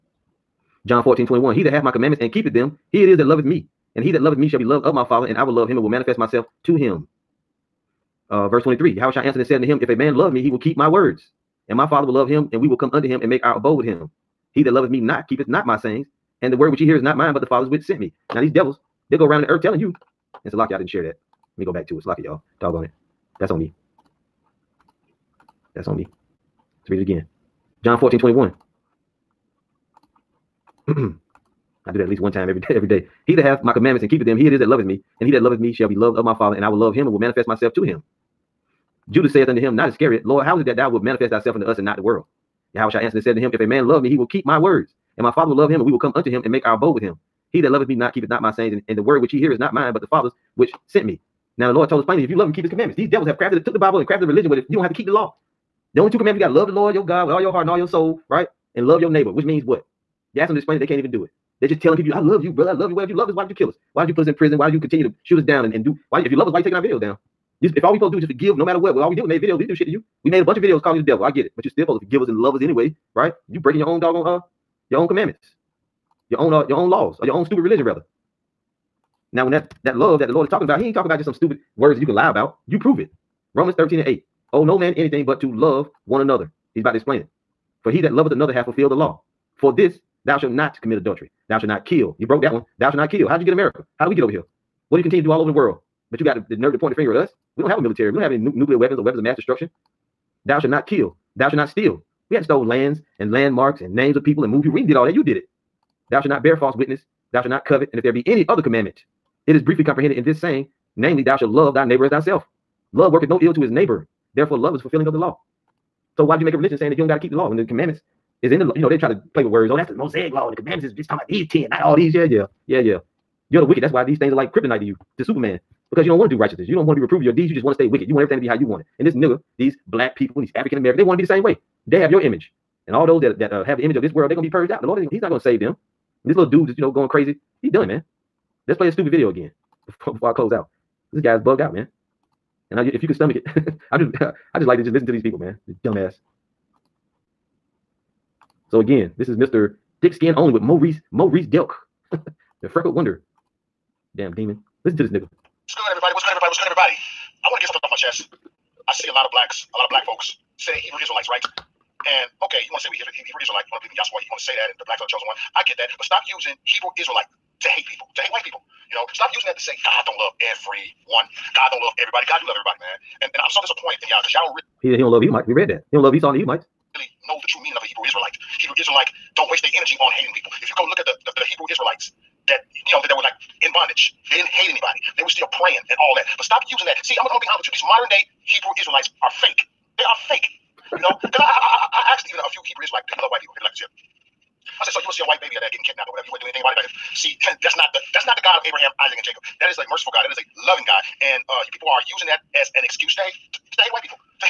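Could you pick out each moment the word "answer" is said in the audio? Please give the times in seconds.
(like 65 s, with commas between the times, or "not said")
9 s, 42 s.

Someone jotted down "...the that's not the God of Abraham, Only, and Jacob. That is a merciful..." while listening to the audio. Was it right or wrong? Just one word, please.
wrong.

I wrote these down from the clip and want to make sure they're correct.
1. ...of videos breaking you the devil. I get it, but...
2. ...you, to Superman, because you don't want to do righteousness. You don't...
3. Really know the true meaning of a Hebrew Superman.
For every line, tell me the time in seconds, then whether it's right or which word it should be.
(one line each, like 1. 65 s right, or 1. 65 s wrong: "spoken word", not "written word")
1. 70 s wrong: "calling", not "breaking"
2. 124 s right
3. 176 s wrong: "Israelite", not "Superman".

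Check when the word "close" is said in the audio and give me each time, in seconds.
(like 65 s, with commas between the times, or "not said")
140 s.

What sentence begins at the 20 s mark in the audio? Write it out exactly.
it's a Salakia, I didn't share that.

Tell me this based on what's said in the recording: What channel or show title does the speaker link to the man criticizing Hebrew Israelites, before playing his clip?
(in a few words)
Mr. Thick Skin Only.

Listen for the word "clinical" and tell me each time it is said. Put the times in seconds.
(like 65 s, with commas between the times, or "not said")
not said.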